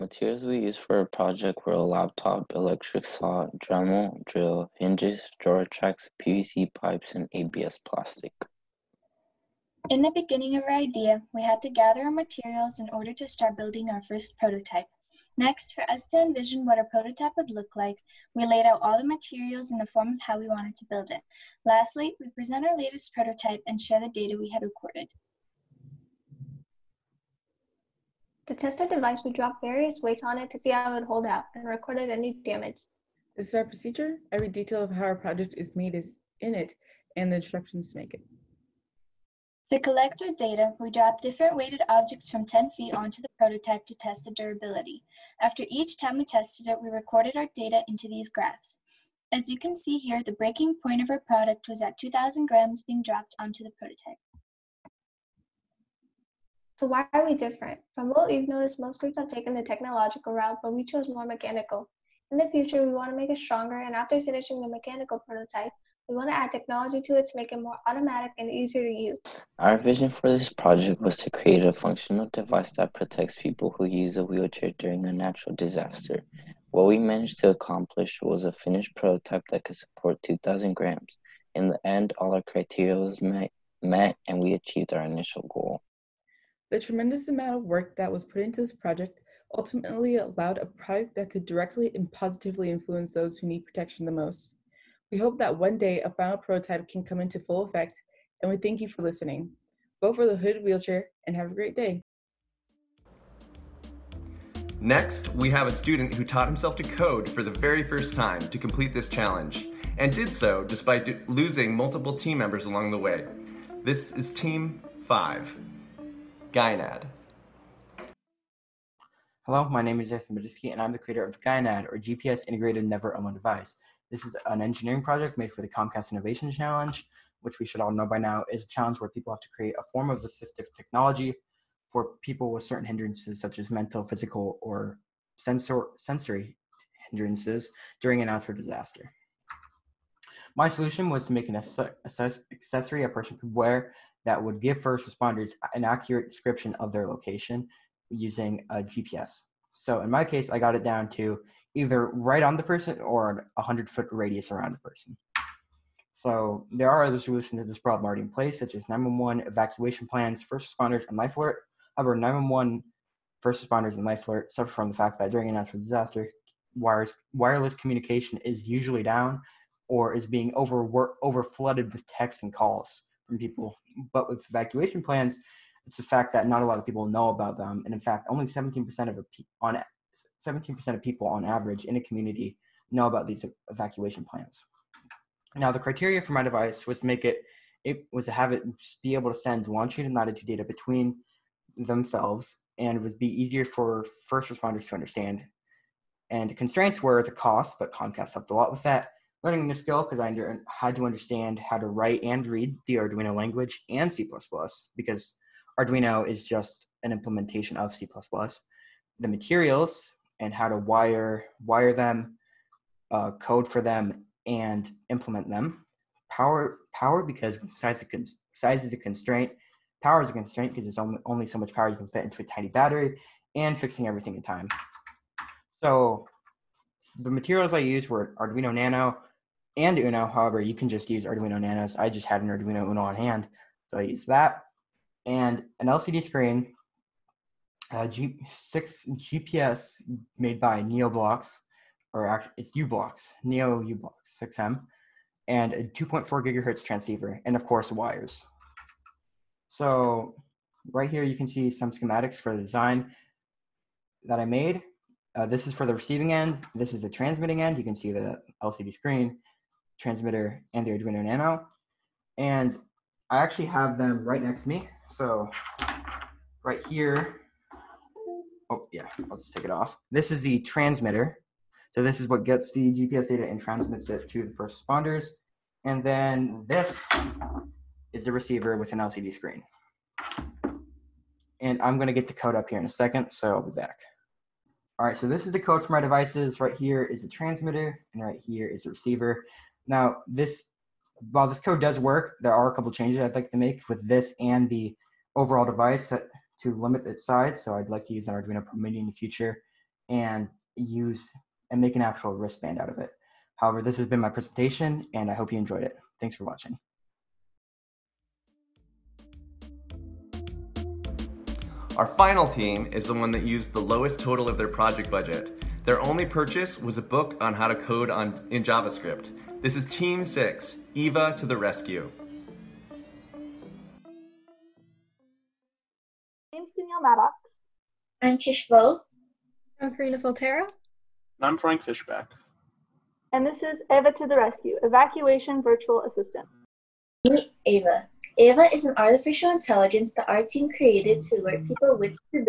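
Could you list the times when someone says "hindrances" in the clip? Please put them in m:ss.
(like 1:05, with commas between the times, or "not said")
2:12, 2:17.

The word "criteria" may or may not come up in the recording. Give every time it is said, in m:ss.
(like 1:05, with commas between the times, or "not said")
1:22, 3:05.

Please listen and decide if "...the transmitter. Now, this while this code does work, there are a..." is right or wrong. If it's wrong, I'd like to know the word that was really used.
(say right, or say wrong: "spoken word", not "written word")
wrong: "receiver", not "transmitter".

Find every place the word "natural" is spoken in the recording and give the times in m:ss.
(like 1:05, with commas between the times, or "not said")
1:15, 2:45.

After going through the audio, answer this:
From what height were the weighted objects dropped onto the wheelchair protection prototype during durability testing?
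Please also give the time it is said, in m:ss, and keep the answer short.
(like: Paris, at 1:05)
10 feet, at 0:42.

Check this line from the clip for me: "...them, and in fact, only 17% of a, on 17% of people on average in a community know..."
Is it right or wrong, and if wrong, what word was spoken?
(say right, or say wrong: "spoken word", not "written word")
right.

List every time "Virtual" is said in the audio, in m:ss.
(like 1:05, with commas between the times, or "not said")
5:35.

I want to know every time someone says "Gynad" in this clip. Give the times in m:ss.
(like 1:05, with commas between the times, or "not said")
1:56, 2:01.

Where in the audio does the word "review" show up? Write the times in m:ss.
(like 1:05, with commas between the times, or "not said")
not said.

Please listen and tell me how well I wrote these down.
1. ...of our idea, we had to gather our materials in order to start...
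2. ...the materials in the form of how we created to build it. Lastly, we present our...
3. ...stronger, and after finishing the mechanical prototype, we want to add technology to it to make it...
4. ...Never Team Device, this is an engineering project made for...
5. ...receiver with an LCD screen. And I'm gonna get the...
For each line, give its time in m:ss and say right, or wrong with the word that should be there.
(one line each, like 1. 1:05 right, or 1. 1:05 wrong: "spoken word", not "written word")
1. 0:10 right
2. 0:18 wrong: "wanted", not "created"
3. 1:03 right
4. 2:02 wrong: "Own", not "Team"
5. 4:38 right.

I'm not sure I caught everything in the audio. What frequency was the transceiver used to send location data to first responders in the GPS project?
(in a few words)
2.4 gigahertz.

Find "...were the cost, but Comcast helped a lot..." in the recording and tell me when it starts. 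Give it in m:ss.
3:17.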